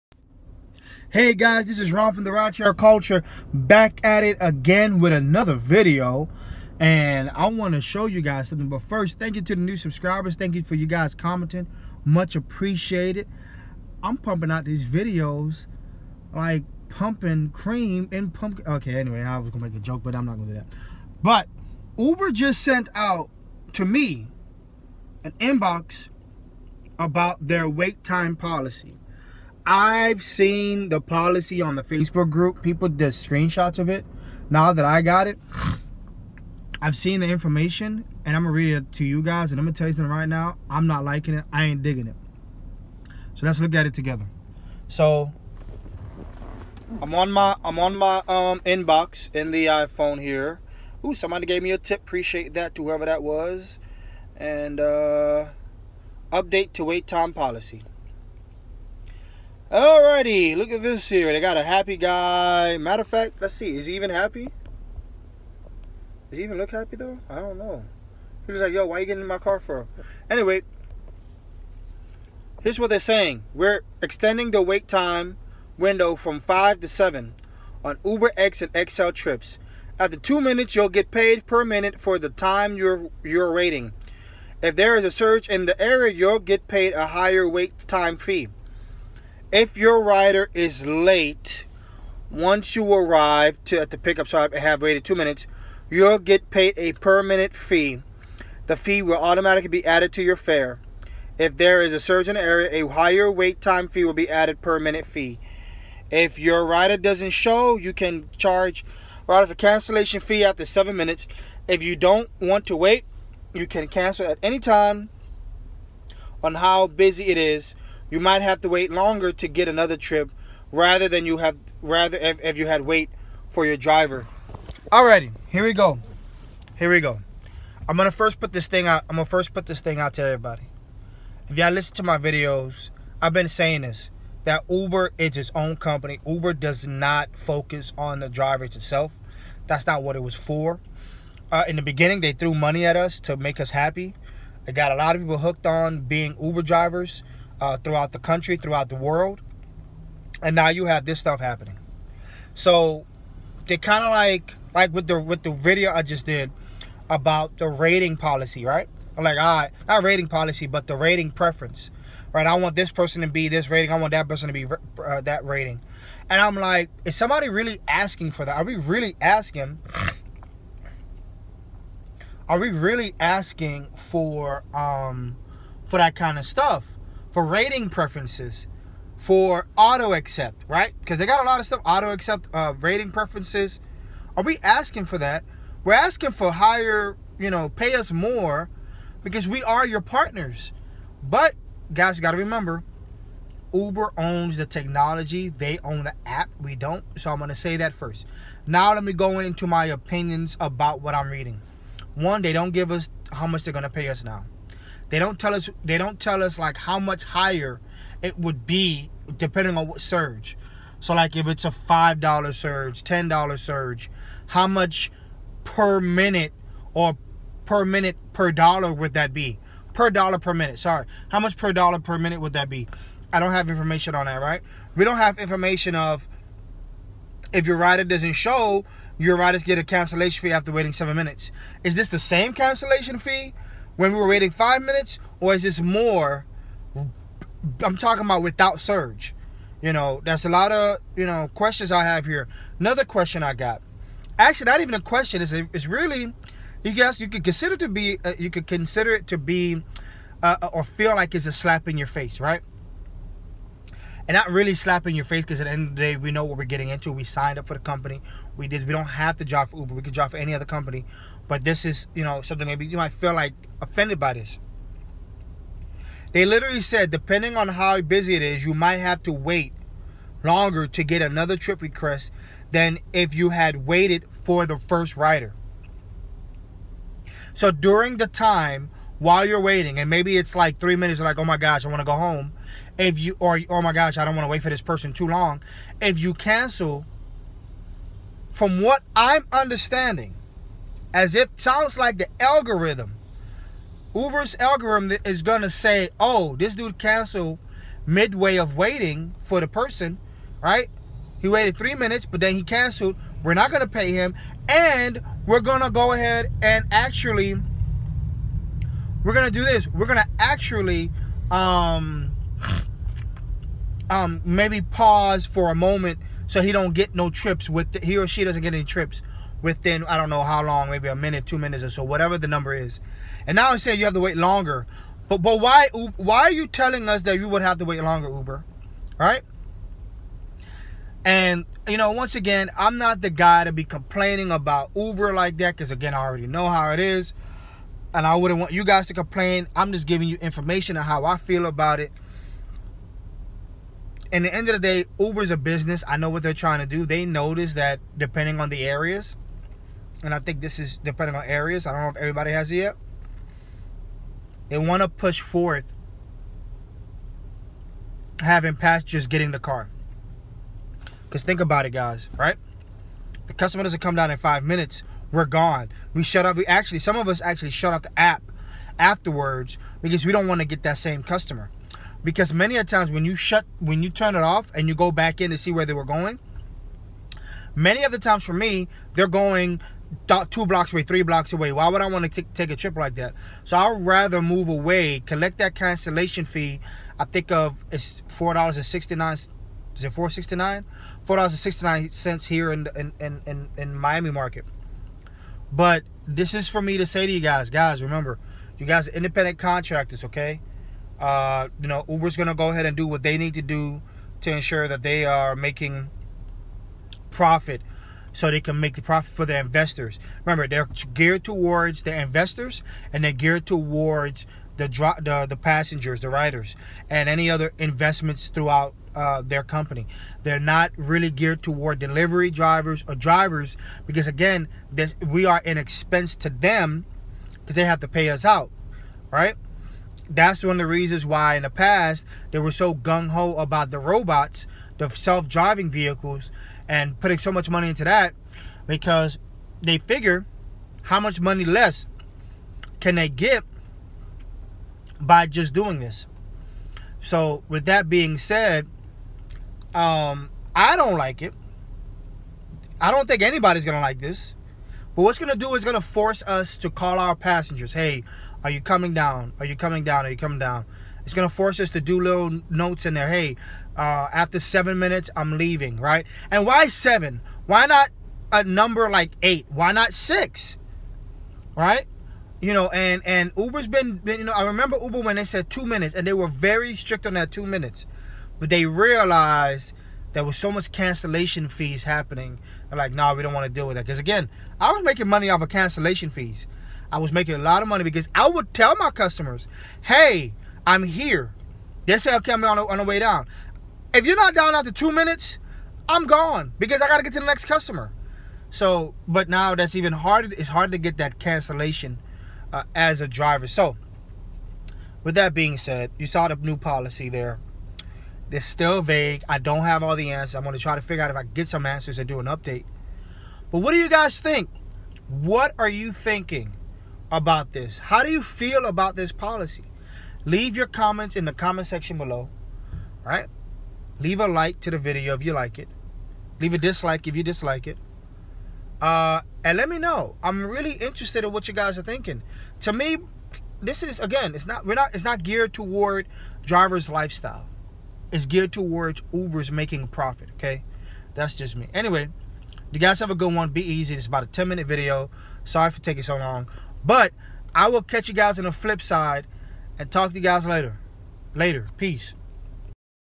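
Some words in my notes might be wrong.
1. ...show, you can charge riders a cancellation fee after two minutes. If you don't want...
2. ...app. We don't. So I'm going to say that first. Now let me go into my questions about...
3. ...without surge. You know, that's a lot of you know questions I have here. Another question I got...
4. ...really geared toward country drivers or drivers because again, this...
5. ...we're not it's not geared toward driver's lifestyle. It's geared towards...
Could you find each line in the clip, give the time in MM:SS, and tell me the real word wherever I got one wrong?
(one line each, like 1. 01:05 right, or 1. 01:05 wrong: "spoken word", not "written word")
1. 01:47 wrong: "seven", not "two"
2. 03:16 wrong: "opinions", not "questions"
3. 03:58 right
4. 07:00 wrong: "delivery", not "country"
5. 08:54 right.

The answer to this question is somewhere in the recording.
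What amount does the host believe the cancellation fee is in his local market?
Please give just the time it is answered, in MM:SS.
06:31.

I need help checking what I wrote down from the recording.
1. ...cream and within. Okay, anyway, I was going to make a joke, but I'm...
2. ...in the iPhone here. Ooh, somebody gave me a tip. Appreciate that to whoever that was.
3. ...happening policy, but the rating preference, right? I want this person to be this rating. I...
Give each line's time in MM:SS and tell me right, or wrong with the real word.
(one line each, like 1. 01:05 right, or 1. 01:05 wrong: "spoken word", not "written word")
1. 00:17 wrong: "pumpkin", not "within"
2. 00:49 right
3. 02:40 wrong: "rating", not "happening".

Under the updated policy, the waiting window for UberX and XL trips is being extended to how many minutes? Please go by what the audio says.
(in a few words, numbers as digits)
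7.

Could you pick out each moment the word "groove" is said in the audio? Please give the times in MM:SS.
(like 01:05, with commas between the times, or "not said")
not said.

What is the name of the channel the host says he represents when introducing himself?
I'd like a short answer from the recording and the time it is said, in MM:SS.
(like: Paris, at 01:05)
RideShare Culture, at 00:02.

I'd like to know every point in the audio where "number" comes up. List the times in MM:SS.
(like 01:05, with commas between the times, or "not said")
05:22, 07:48.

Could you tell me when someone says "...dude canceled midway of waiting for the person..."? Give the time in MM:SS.
04:56.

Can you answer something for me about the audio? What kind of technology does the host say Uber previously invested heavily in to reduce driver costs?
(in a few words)
self driving vehicles.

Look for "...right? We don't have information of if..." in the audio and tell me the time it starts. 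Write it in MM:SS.
03:44.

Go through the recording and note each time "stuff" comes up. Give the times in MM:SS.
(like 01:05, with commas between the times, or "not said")
02:31, 02:56, 03:01.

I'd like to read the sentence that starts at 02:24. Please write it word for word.
It got a lot of people hooked on being Uber drivers uh, throughout the country, throughout the world.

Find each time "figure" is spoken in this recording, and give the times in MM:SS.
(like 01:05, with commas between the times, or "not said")
07:19, 08:31.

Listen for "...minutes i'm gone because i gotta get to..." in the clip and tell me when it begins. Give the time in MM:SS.
08:15.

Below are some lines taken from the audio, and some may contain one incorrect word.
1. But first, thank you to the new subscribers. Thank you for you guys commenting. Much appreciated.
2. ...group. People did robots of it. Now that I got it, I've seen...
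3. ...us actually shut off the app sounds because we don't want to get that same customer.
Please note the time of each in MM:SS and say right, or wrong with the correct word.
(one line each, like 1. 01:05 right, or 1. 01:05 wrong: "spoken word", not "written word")
1. 00:08 right
2. 00:32 wrong: "screenshots", not "robots"
3. 06:07 wrong: "afterwards", not "sounds".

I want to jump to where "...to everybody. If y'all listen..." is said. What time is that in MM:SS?
02:10.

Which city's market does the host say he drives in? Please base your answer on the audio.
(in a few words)
Miami.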